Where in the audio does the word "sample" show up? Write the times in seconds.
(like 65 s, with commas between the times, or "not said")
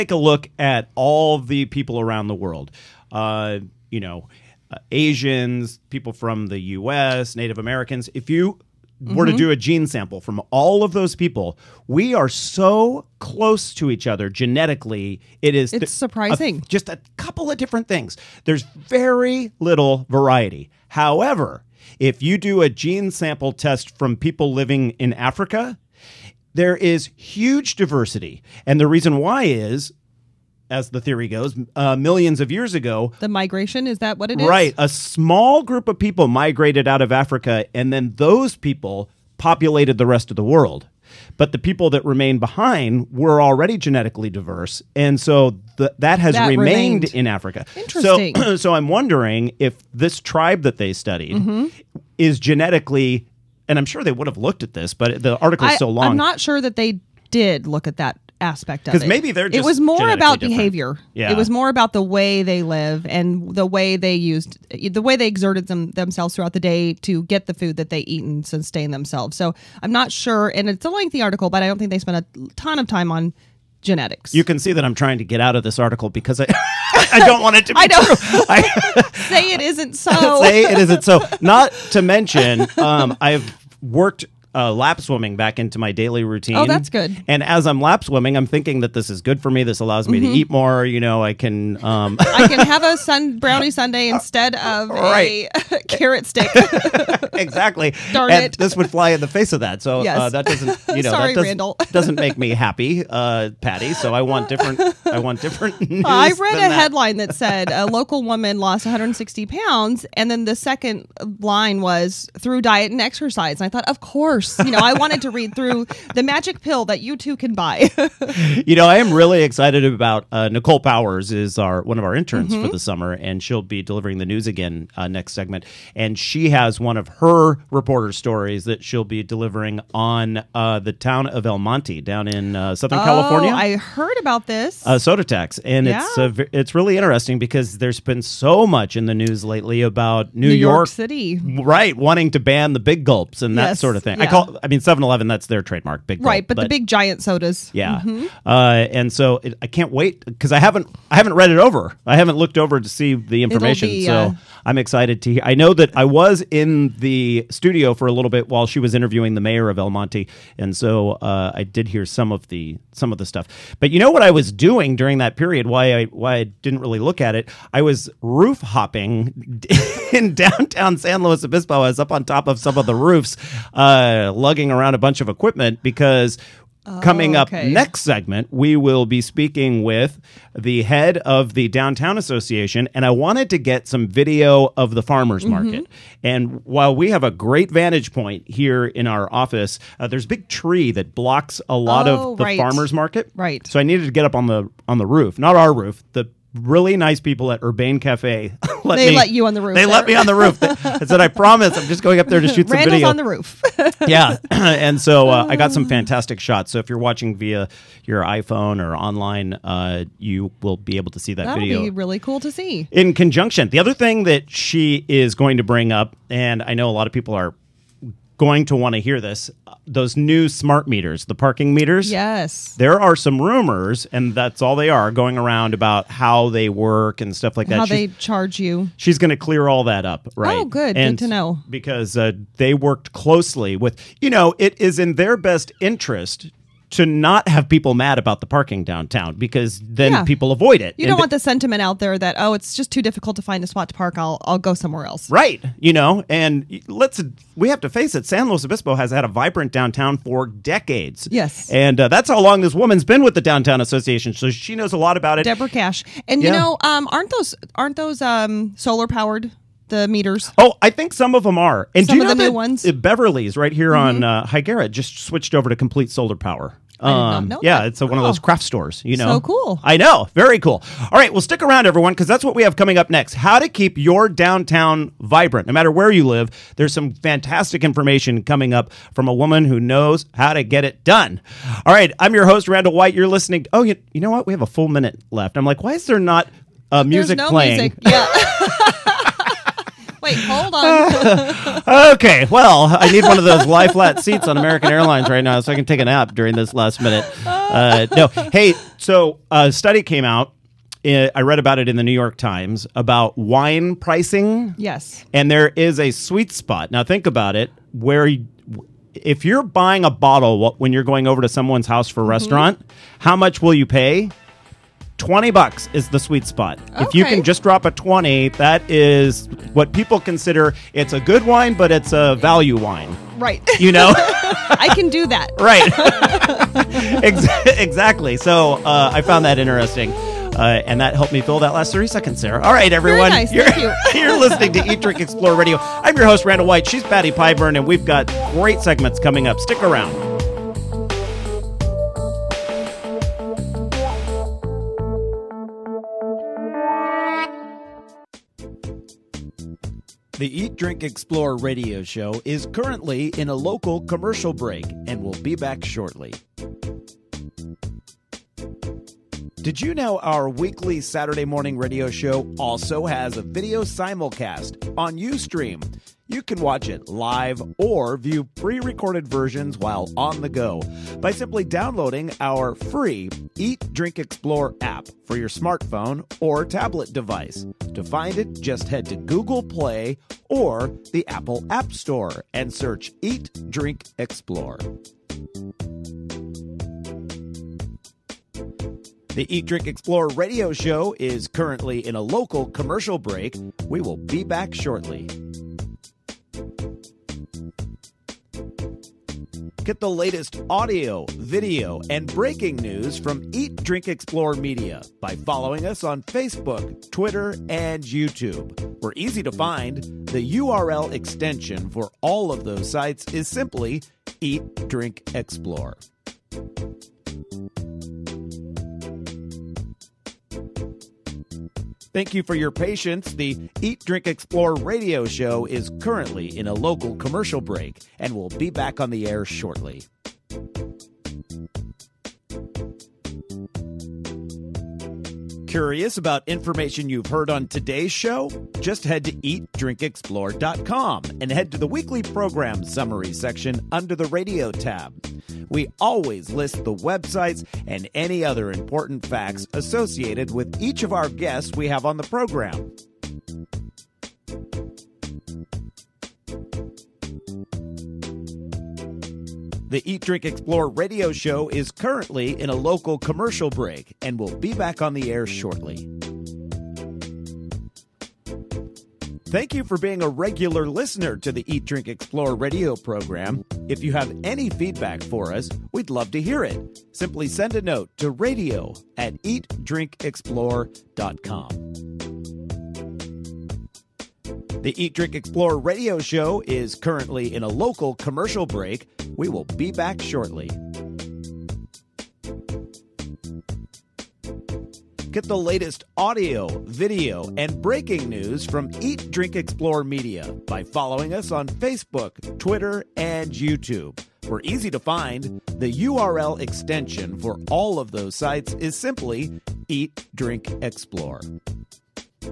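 9 s, 23 s.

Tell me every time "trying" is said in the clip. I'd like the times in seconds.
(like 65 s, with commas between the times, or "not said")
74 s.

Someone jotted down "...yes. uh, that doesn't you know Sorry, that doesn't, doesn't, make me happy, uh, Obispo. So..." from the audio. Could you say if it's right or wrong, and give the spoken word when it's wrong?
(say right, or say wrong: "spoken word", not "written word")
wrong: "Patty", not "Obispo".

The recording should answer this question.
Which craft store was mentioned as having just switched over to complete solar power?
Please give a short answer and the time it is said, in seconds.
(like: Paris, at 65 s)
Beverly's, at 262 s.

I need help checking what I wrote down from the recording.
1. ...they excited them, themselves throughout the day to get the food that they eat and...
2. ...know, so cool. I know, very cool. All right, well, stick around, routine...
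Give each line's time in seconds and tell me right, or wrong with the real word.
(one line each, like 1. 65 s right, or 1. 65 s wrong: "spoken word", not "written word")
1. 65 s wrong: "exerted", not "excited"
2. 269 s wrong: "everyone", not "routine".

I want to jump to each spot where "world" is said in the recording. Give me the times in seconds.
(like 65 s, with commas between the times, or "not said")
2 s, 40 s.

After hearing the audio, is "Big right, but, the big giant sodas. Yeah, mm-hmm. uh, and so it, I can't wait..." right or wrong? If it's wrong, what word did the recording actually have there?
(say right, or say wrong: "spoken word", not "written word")
right.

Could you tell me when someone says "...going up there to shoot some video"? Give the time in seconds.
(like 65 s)
202 s.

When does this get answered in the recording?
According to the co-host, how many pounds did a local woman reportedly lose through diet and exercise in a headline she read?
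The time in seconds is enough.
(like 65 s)
108 s.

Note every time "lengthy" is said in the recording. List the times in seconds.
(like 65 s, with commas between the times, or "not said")
70 s.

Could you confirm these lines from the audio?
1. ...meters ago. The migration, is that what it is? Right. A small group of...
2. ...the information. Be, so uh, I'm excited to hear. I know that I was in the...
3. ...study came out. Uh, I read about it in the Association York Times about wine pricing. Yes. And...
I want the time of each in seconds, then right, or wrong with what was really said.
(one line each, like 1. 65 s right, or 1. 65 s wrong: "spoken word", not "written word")
1. 32 s wrong: "years", not "meters"
2. 153 s right
3. 299 s wrong: "New", not "Association".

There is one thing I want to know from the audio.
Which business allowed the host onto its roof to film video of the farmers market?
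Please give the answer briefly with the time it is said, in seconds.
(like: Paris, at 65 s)
Urbane Cafe, at 197 s.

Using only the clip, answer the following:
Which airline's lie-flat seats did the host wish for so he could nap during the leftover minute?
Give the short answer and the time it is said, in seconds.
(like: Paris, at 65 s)
American Airlines, at 294 s.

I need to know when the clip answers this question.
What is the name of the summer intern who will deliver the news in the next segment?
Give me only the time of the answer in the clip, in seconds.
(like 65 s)
120 s.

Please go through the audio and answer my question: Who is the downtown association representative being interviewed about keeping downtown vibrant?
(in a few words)
Deborah Cash.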